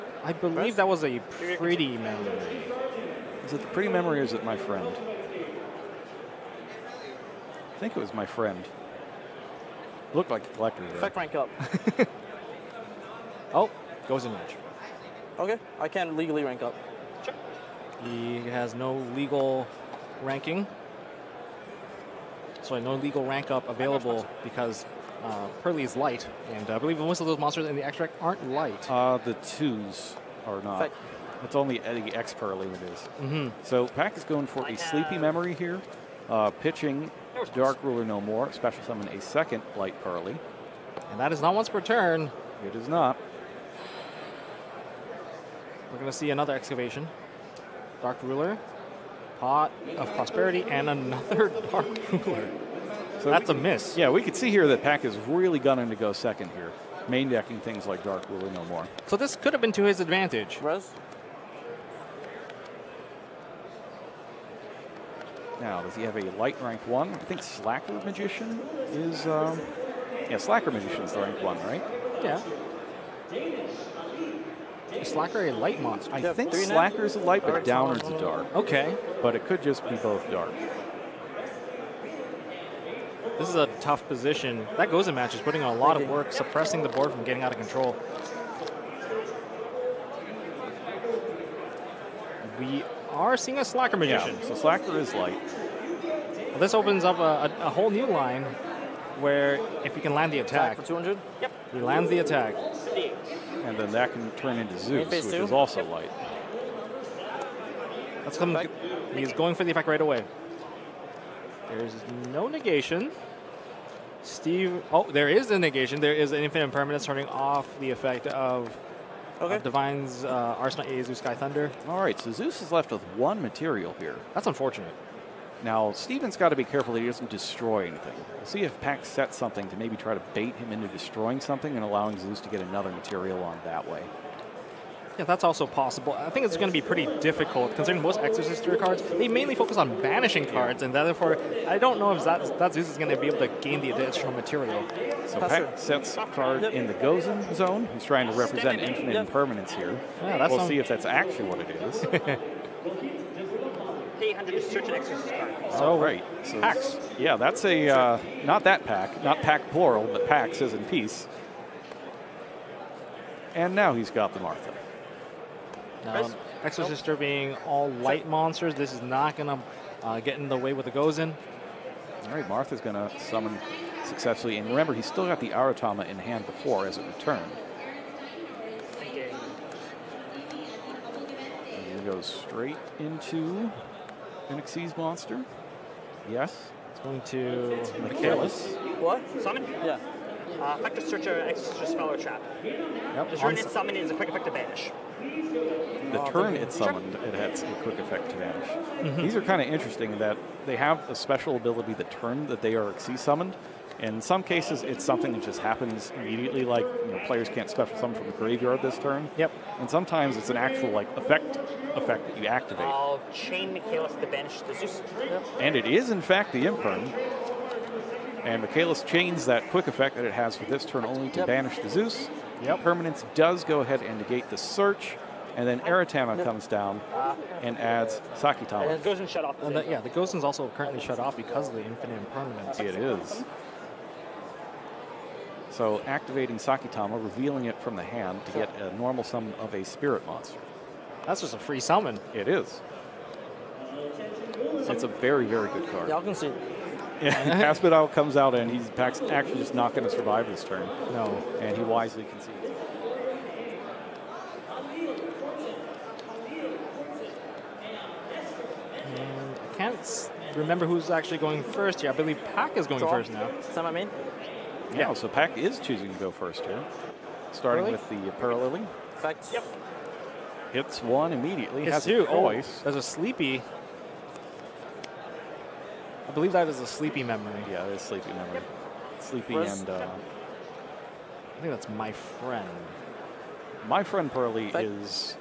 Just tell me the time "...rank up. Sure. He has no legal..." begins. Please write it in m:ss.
0:16.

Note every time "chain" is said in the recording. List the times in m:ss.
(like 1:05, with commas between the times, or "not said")
3:33, 3:39.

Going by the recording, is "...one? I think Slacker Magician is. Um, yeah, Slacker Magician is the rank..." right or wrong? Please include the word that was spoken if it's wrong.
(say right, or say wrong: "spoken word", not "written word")
right.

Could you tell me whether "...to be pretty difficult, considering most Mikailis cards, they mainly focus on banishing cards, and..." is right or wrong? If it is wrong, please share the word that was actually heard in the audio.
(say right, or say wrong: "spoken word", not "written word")
wrong: "Exosister", not "Mikailis".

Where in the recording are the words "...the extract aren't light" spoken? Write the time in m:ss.
0:27.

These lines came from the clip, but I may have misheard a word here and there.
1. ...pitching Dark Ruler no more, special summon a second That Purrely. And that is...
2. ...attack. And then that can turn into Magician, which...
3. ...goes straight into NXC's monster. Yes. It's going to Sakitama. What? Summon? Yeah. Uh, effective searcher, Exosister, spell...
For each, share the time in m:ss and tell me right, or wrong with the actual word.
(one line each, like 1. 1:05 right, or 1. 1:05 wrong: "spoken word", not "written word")
1. 0:36 wrong: "Light", not "That"
2. 1:42 wrong: "Zeus", not "Magician"
3. 3:02 wrong: "Mikailis", not "Sakitama".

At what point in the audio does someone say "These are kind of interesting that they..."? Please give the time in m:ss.
3:19.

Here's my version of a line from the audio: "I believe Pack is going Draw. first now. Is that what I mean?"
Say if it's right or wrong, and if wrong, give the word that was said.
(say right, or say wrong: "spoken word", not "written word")
right.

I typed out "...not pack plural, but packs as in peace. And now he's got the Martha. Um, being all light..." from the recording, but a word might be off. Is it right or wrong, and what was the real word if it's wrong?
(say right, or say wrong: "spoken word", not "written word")
right.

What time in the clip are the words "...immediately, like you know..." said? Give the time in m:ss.
3:26.